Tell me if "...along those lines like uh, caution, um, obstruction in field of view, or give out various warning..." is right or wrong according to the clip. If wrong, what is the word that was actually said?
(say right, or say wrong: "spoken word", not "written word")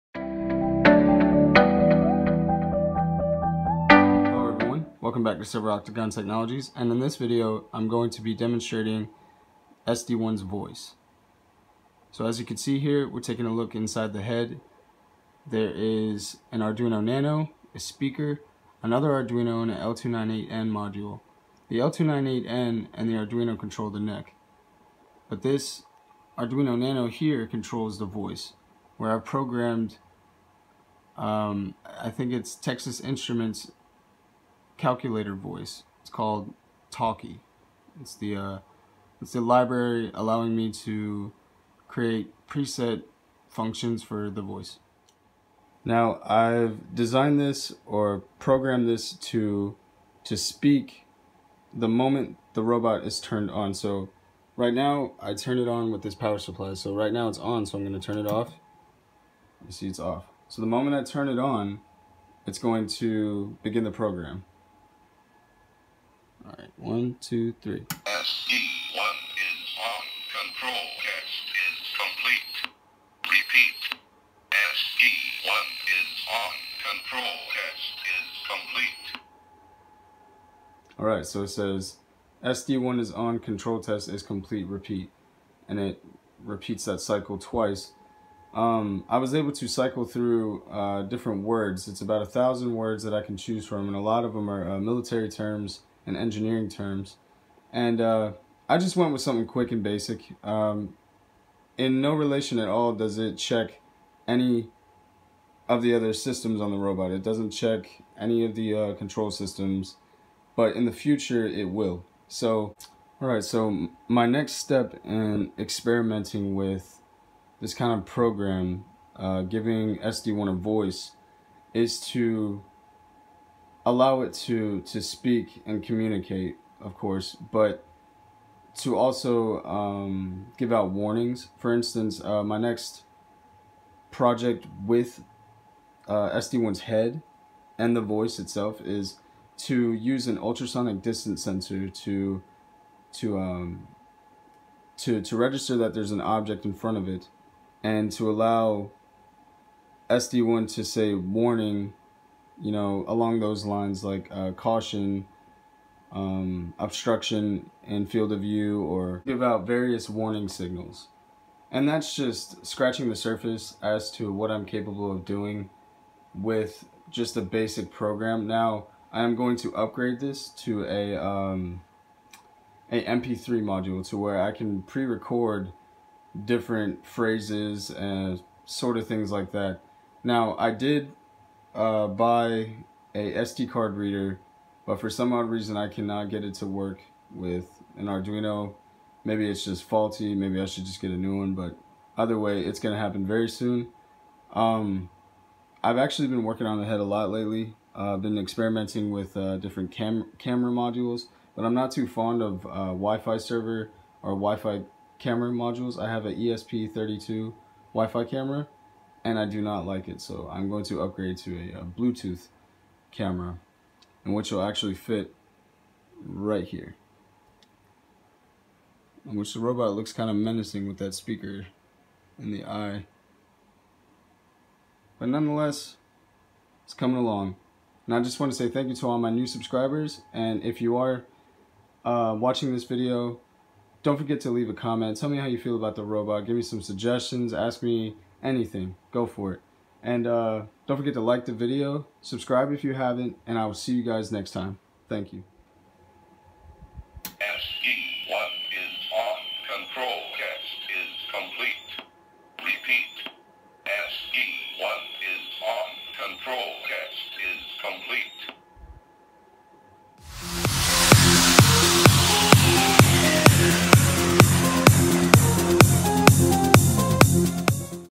right.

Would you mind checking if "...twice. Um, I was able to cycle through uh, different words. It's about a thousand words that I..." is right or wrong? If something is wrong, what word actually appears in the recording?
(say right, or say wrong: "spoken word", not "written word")
right.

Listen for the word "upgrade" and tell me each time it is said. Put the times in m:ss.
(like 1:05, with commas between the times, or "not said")
2:49, 3:31.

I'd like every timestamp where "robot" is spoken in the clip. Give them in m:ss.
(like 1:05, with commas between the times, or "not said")
0:52, 1:46, 3:39, 3:56.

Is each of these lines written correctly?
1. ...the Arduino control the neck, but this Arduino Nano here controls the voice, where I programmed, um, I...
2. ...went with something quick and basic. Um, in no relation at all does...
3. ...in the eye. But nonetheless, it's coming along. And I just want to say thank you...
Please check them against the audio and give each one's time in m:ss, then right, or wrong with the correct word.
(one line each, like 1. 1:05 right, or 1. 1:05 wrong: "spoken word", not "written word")
1. 0:23 right
2. 1:38 right
3. 3:42 right.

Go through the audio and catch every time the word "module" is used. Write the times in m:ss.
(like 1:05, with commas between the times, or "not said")
0:20, 2:53, 3:20, 3:25.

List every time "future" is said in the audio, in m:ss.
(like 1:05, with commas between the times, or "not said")
1:50.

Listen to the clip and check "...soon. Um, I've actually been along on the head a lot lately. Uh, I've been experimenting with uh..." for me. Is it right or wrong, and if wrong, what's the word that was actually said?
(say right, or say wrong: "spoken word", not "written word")
wrong: "working", not "along".